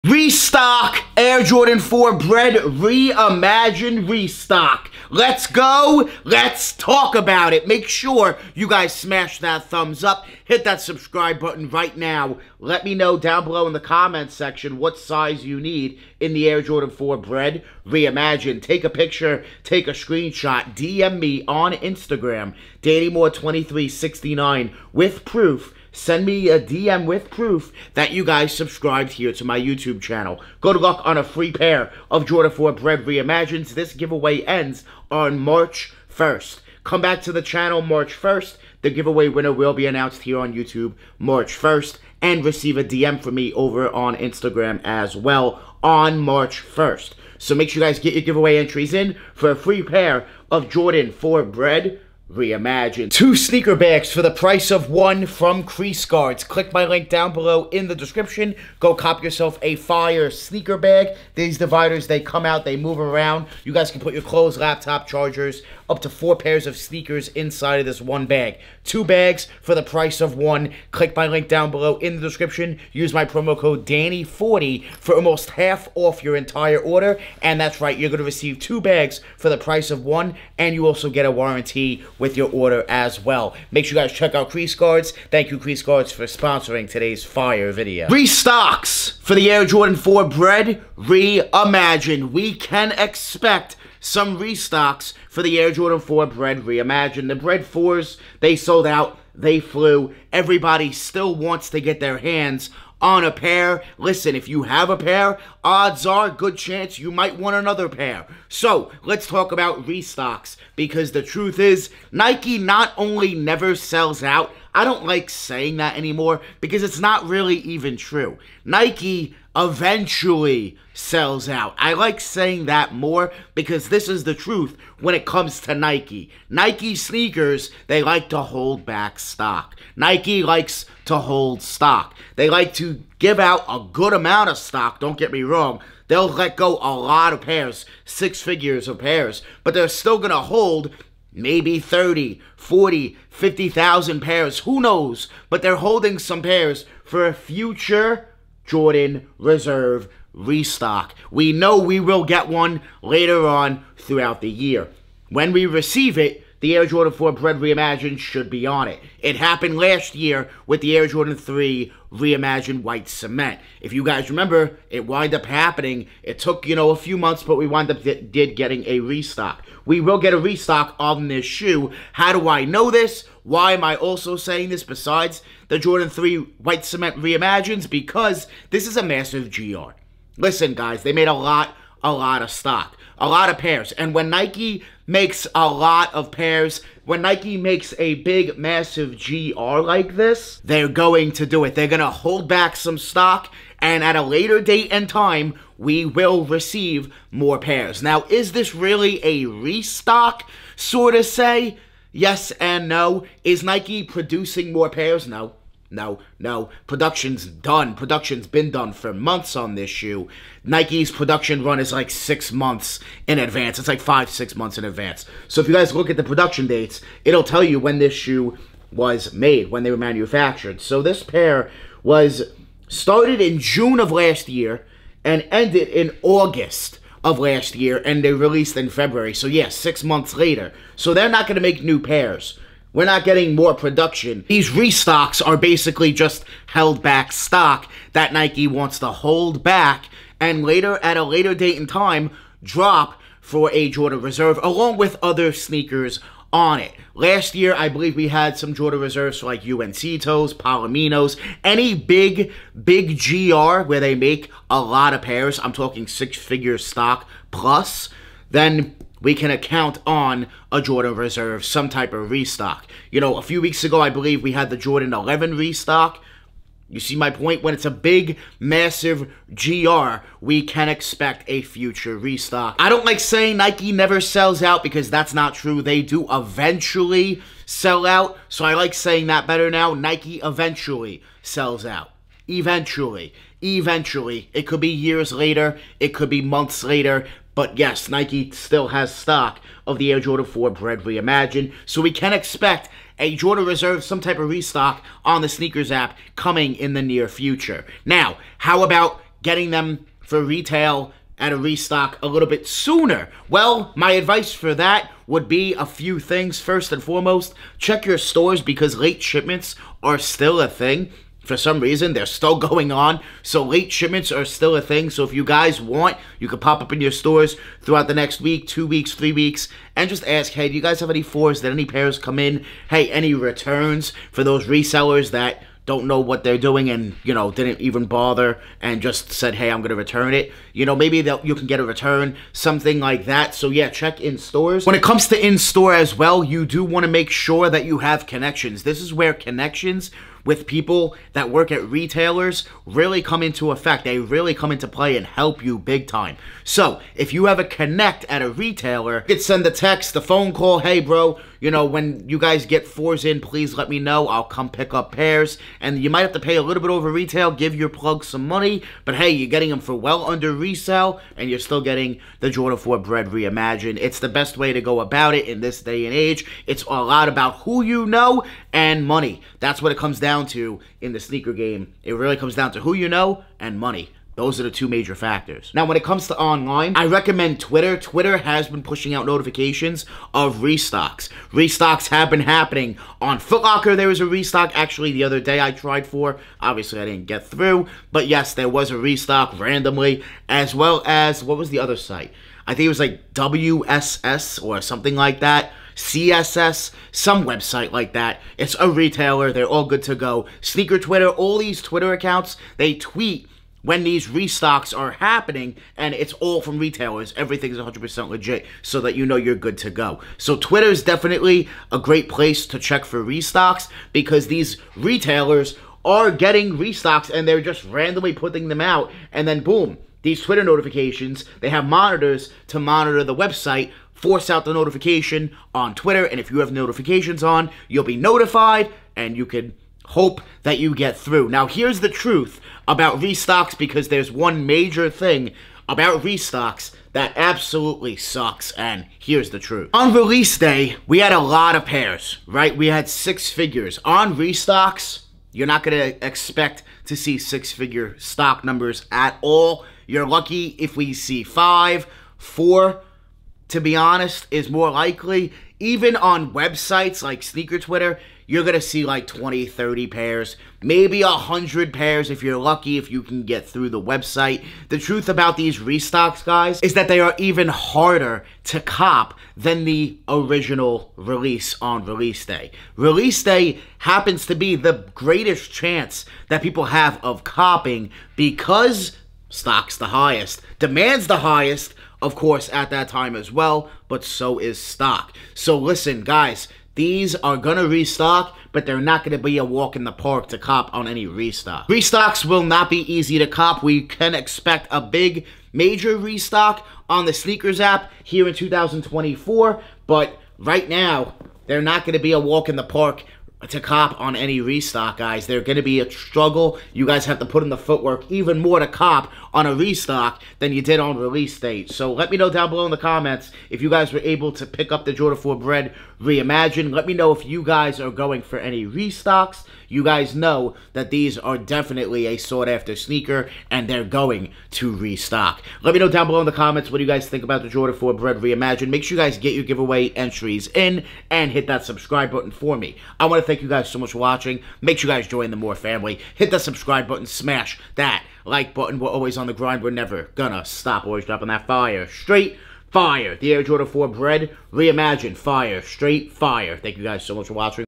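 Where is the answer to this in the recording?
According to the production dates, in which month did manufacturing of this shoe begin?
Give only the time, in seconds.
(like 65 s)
223 s.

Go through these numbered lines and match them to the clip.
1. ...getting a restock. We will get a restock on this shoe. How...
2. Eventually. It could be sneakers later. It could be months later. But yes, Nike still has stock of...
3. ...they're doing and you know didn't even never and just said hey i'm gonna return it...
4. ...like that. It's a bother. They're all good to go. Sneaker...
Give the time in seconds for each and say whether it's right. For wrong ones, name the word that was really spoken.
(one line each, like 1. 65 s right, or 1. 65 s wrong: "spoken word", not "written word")
1. 168 s right
2. 283 s wrong: "years", not "sneakers"
3. 326 s wrong: "bother", not "never"
4. 397 s wrong: "retailer", not "bother".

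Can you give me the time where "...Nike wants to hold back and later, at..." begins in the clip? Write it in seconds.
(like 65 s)
238 s.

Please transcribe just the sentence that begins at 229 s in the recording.
So yes, yeah, six months later.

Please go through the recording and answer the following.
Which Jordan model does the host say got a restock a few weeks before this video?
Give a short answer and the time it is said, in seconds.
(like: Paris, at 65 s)
Jordan 11, at 264 s.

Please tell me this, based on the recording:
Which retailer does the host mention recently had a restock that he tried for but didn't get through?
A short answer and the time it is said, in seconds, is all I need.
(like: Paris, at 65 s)
Foot Locker, at 383 s.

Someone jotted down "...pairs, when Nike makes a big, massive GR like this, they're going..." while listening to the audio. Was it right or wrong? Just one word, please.
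right.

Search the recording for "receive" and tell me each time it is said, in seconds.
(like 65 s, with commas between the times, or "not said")
42 s, 78 s, 155 s, 196 s.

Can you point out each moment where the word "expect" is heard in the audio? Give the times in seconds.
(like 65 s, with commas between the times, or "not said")
92 s, 270 s, 292 s, 446 s, 494 s.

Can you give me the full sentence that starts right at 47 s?
So make sure you guys get your giveaway entries in for a free pair of Jordan 4 Bred reimagined.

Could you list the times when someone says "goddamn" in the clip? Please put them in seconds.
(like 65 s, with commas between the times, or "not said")
not said.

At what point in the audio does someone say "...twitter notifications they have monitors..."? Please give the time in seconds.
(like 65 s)
420 s.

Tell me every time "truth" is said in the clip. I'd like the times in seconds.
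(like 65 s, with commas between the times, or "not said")
111 s, 124 s, 432 s, 439 s, 464 s.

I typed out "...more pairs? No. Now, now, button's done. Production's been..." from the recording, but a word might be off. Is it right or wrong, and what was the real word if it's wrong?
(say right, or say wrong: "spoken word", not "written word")
wrong: "production", not "button".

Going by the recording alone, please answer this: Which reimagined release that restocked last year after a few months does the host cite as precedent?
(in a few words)
Air Jordan 3 Reimagined White Cement.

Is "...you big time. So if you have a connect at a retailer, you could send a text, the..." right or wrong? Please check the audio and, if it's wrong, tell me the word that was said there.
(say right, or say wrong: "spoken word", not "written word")
right.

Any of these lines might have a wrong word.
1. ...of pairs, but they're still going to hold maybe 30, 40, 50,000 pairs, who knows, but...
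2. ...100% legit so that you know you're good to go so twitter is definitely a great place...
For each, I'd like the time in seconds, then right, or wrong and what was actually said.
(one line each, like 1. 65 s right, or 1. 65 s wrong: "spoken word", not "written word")
1. 138 s right
2. 407 s right.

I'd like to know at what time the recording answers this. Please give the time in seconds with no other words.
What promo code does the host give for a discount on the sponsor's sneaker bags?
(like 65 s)
73 s.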